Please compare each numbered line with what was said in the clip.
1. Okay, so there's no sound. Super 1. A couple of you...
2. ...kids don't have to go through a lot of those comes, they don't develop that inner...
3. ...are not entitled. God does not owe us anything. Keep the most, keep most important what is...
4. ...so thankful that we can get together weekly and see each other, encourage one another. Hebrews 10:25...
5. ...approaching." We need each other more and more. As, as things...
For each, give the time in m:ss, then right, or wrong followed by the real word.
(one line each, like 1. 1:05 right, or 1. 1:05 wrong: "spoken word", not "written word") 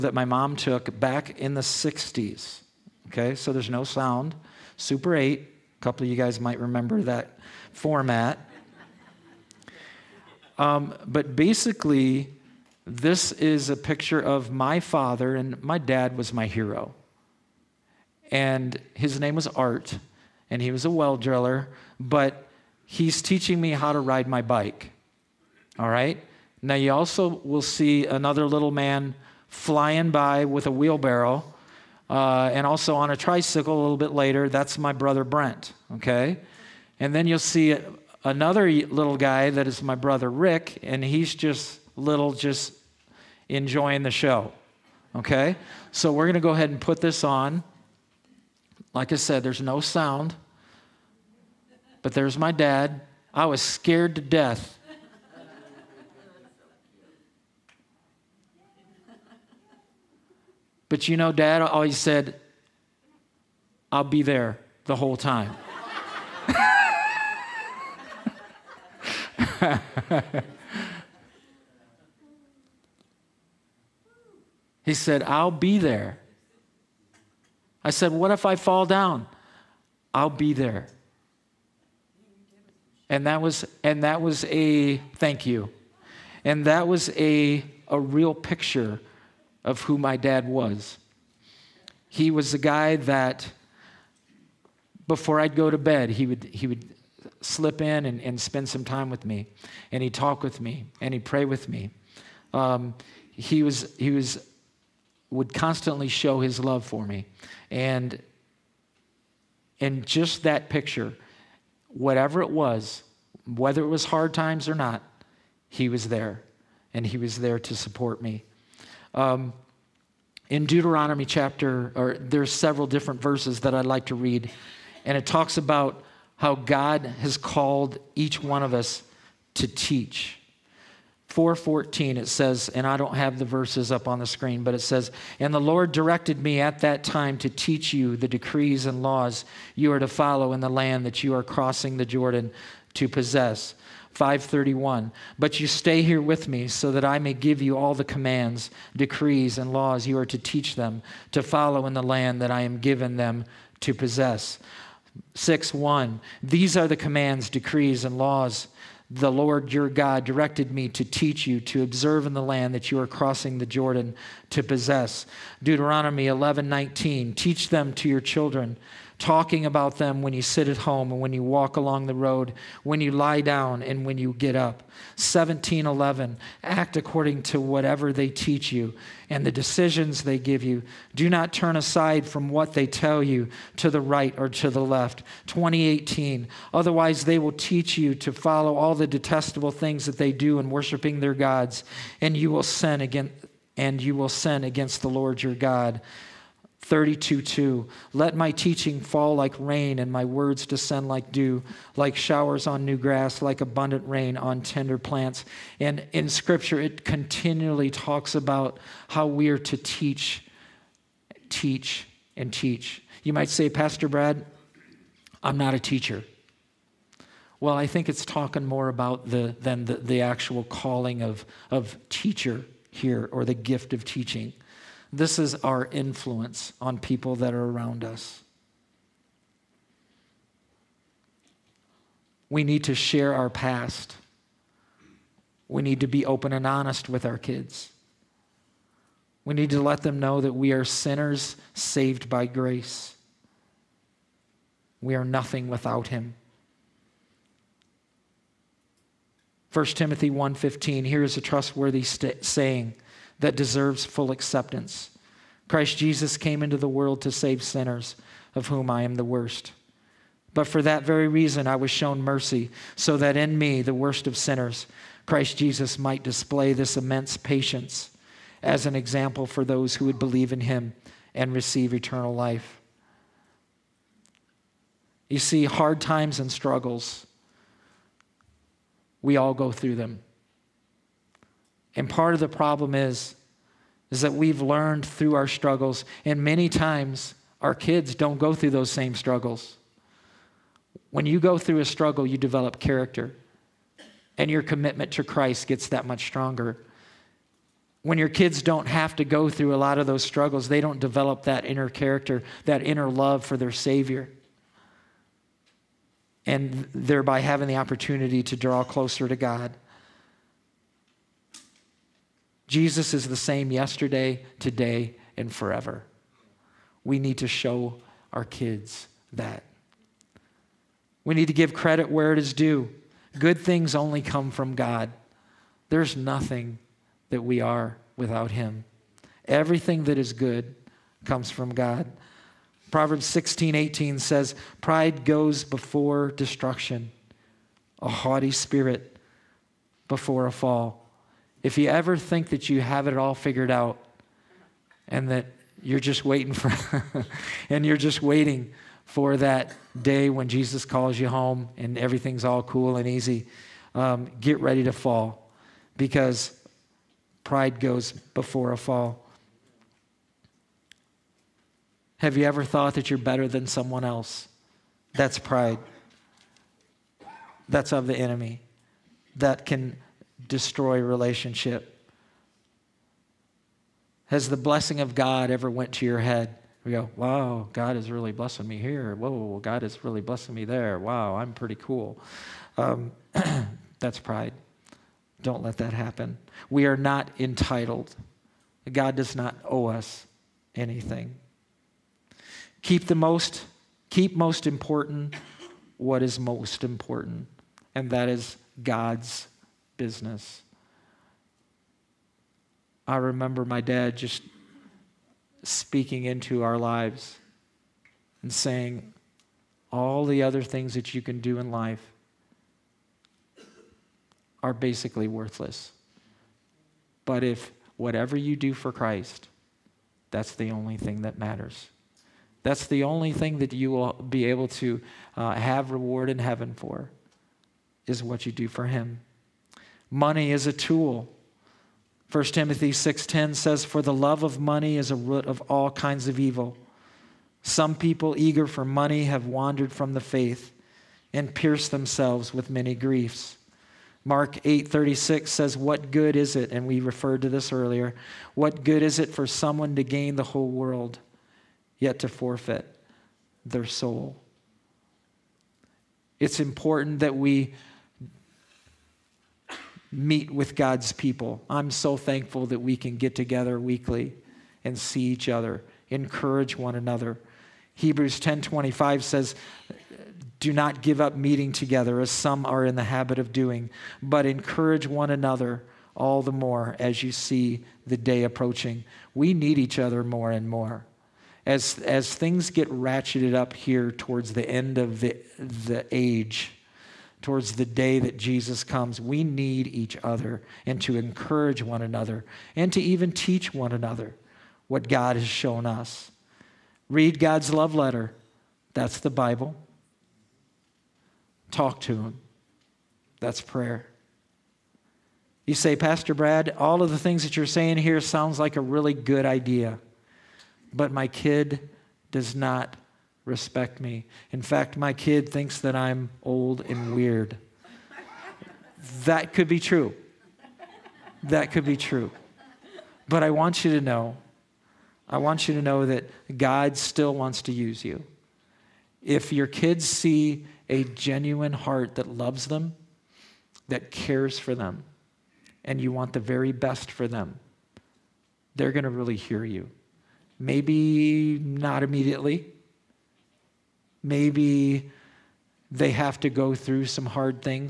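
1. 0:03 wrong: "8", not "1"
2. 4:58 wrong: "struggles", not "comes"
3. 6:26 right
4. 7:41 right
5. 7:58 right.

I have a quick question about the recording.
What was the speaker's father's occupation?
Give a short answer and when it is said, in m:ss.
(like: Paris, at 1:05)
well driller, at 0:20.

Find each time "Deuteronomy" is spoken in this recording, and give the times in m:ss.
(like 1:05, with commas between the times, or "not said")
2:00, 2:45.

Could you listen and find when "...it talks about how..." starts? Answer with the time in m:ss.
2:05.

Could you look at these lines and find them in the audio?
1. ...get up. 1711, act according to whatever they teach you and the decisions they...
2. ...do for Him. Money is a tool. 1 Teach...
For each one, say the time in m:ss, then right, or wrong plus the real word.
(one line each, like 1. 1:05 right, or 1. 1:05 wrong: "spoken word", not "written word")
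1. 2:54 right
2. 7:08 wrong: "Timothy", not "Teach".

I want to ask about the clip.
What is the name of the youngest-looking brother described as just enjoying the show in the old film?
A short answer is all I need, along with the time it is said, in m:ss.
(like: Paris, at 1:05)
Rick, at 0:40.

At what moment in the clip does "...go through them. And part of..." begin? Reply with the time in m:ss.
4:39.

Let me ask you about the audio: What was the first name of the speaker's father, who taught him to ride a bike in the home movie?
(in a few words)
Art.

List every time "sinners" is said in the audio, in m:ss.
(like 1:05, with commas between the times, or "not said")
4:00, 4:17, 4:24.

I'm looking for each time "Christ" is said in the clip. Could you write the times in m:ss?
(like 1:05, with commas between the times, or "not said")
4:15, 4:25, 4:55, 6:58.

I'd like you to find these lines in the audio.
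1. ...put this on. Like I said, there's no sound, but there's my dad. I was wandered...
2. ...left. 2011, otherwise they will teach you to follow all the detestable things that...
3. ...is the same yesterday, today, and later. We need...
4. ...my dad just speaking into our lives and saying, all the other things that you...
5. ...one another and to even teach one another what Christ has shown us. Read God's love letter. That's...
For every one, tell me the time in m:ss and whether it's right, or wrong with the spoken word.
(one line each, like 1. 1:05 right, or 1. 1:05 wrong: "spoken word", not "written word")
1. 0:46 wrong: "scared", not "wandered"
2. 3:04 wrong: "2018", not "2011"
3. 5:13 wrong: "forever", not "later"
4. 6:43 right
5. 8:11 wrong: "God", not "Christ".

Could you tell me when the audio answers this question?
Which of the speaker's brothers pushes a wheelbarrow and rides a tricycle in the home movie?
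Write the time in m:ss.
0:35.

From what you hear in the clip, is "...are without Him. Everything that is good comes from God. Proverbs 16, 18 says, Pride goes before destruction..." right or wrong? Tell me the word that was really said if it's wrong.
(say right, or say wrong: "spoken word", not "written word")
right.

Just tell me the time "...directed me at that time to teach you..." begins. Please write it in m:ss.
2:15.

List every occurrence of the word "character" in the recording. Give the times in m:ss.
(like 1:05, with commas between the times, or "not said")
4:52, 5:01.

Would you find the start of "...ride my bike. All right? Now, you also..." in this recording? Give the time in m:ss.
0:23.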